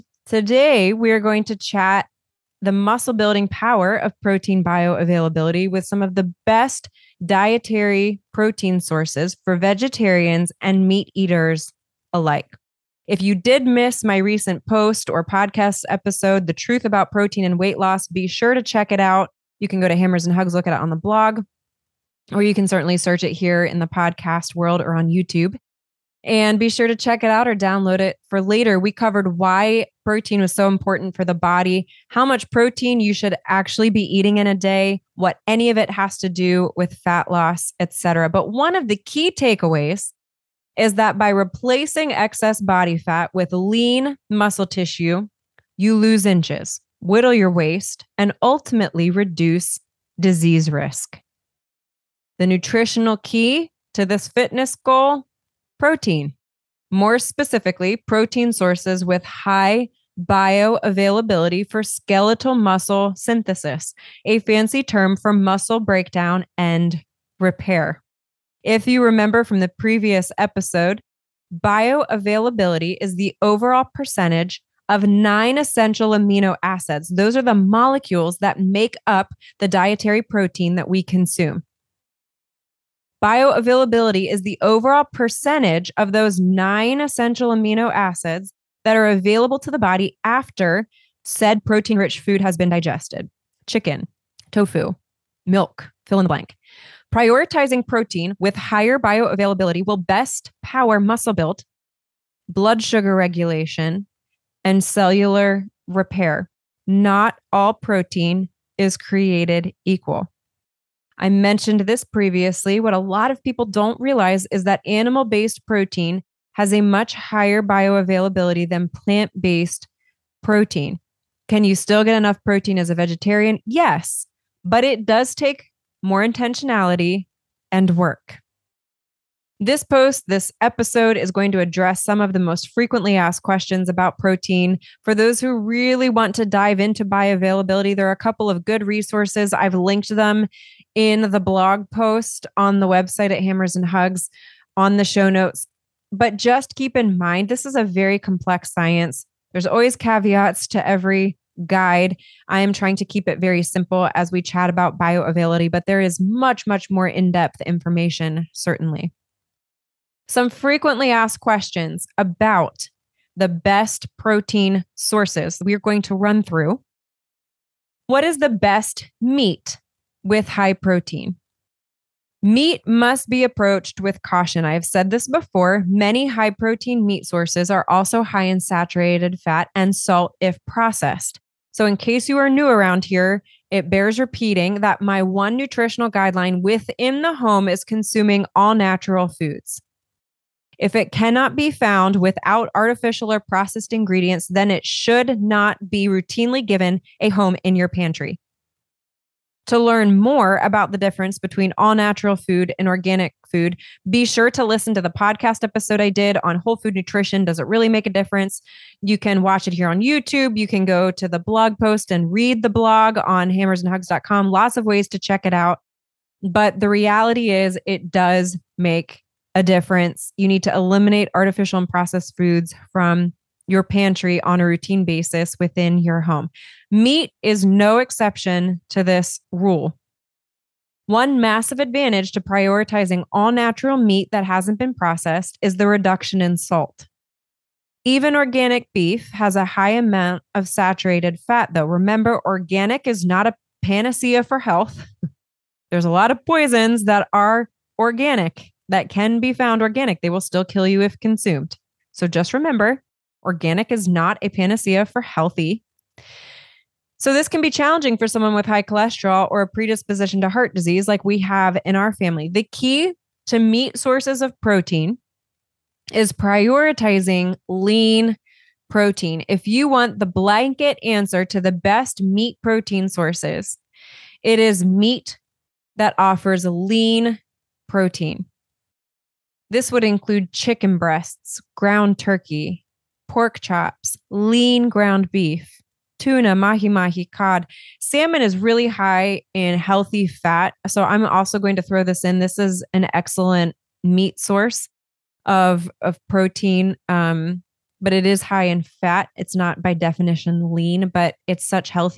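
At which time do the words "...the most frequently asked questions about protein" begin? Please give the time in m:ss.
2:12.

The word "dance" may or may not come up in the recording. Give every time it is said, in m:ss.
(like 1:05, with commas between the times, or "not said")
not said.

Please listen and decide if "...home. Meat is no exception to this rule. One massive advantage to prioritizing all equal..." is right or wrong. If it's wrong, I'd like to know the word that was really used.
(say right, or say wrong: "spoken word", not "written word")
wrong: "natural", not "equal".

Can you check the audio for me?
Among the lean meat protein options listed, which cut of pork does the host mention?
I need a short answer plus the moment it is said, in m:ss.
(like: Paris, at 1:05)
pork chops, at 4:43.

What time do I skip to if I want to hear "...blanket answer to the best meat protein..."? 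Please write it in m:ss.
4:30.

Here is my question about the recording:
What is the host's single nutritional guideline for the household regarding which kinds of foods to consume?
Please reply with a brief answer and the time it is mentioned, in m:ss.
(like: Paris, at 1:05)
all natural foods, at 3:08.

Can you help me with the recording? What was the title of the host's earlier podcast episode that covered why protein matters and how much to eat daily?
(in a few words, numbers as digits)
The Truth About Protein and Weight Loss.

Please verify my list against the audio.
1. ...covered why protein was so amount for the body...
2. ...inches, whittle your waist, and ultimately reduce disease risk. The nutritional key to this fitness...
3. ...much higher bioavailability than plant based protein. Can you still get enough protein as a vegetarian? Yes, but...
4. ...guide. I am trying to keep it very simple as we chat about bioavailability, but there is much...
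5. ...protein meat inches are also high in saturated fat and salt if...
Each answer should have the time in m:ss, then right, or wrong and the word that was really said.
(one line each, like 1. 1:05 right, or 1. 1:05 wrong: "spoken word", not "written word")
1. 0:28 wrong: "important", not "amount"
2. 0:46 right
3. 1:56 right
4. 2:31 right
5. 2:56 wrong: "sources", not "inches".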